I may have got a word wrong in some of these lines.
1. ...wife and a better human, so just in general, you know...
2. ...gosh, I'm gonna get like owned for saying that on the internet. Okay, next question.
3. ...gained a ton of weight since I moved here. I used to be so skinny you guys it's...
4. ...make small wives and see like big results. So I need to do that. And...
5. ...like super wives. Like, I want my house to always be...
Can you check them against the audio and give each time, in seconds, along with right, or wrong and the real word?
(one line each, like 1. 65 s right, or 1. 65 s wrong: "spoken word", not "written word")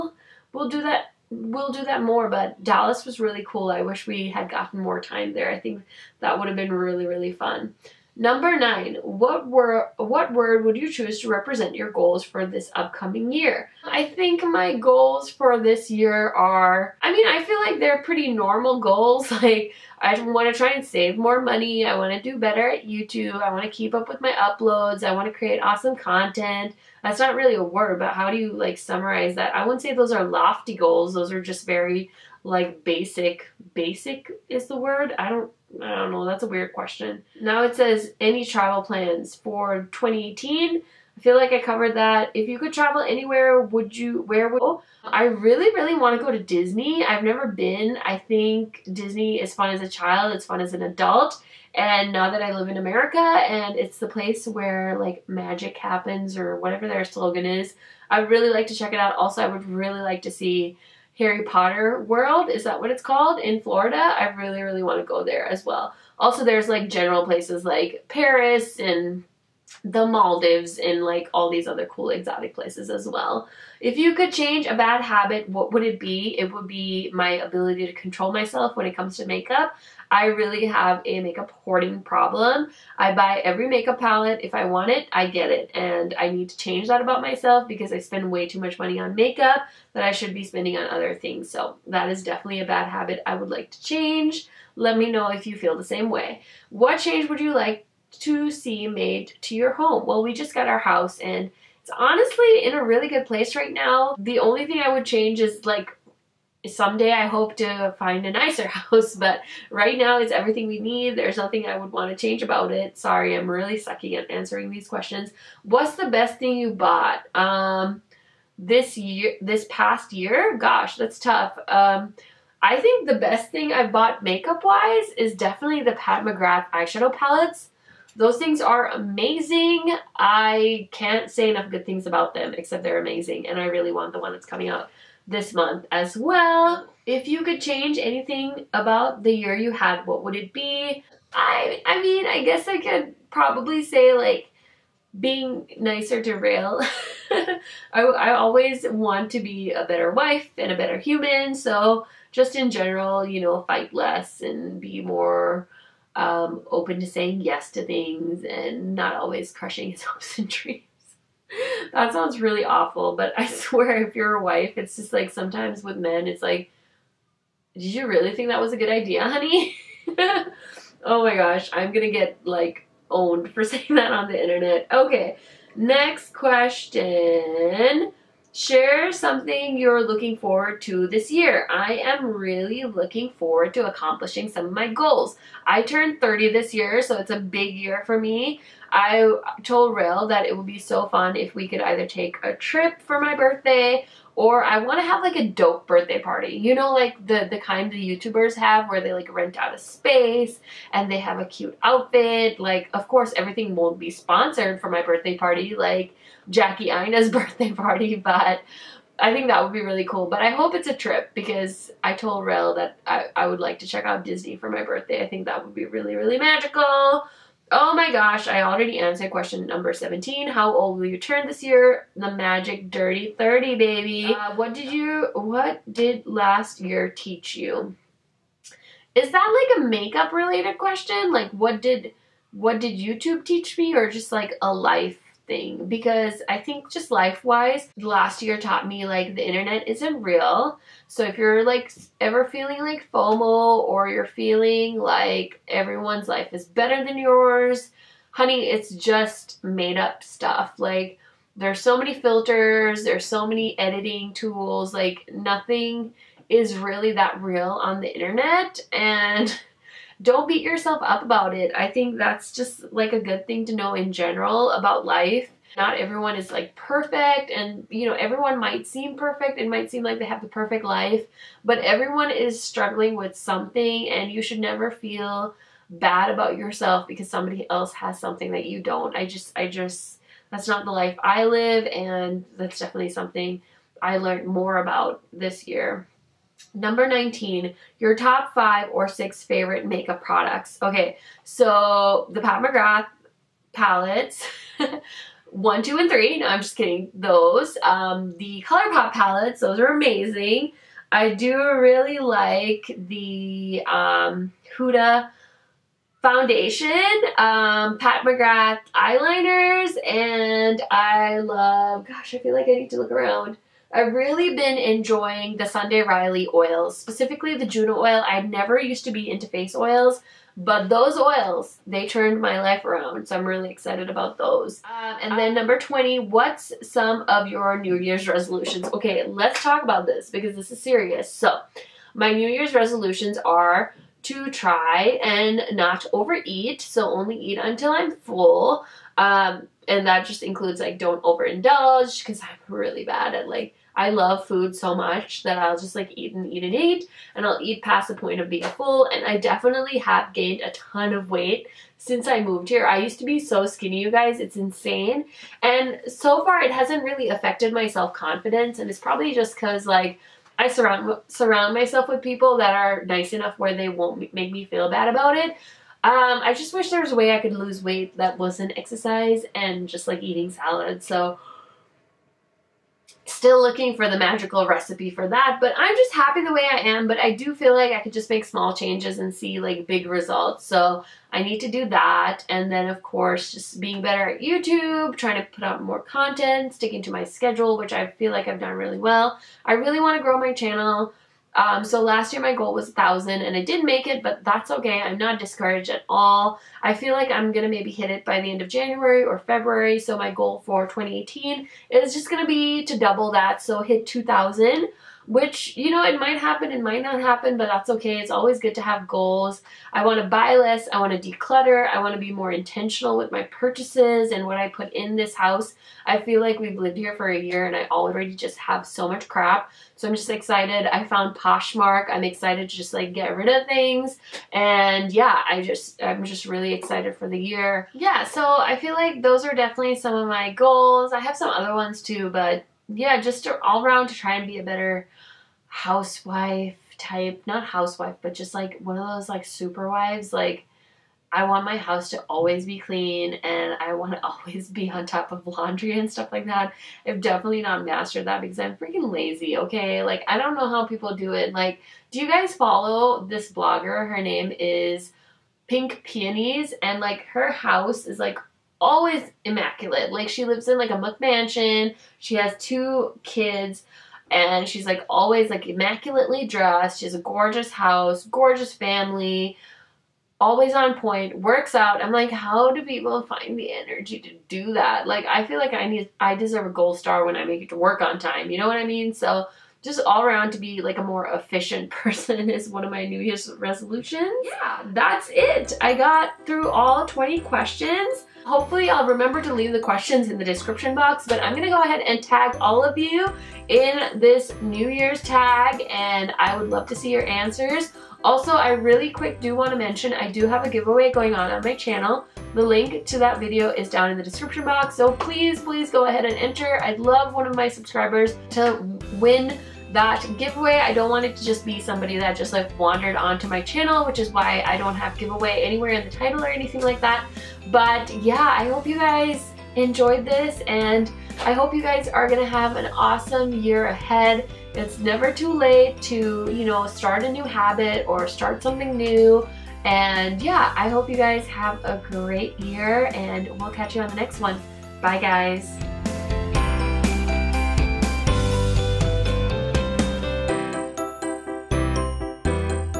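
1. 150 s right
2. 171 s right
3. 350 s right
4. 378 s wrong: "changes", not "wives"
5. 439 s right.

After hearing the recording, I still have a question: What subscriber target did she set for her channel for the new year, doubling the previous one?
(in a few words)
2,000.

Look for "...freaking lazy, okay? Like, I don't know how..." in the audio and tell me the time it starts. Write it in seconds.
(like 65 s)
448 s.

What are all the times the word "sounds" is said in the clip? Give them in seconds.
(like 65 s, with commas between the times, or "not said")
162 s.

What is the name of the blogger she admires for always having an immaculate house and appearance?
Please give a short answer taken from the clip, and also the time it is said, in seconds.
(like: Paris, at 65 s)
Pink Peonies, at 455 s.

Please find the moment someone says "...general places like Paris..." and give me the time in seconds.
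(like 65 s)
66 s.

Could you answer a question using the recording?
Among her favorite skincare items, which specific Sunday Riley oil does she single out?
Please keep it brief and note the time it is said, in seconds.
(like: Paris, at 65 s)
Juno oil, at 317 s.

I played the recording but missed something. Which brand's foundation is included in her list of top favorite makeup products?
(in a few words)
Huda.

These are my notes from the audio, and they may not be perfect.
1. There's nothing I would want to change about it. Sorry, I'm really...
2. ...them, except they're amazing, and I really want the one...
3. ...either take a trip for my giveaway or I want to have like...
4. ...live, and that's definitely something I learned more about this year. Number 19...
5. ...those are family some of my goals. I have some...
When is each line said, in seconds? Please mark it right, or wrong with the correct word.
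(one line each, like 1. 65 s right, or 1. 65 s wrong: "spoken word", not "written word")
1. 111 s right
2. 132 s right
3. 191 s wrong: "birthday", not "giveaway"
4. 281 s right
5. 429 s wrong: "definitely", not "family".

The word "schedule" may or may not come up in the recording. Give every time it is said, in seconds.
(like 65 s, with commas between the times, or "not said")
387 s.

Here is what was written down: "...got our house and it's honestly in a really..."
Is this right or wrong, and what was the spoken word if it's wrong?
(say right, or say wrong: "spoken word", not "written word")
right.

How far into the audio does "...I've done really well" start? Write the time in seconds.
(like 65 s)
388 s.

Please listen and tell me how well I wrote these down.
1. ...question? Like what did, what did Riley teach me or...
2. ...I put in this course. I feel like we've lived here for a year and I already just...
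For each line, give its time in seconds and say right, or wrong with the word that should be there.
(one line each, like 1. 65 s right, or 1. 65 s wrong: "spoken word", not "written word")
1. 230 s wrong: "YouTube", not "Riley"
2. 414 s wrong: "house", not "course".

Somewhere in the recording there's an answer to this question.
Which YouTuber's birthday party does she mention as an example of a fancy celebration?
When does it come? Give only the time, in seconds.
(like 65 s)
206 s.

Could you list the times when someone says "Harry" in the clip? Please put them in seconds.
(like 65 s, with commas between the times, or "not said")
61 s.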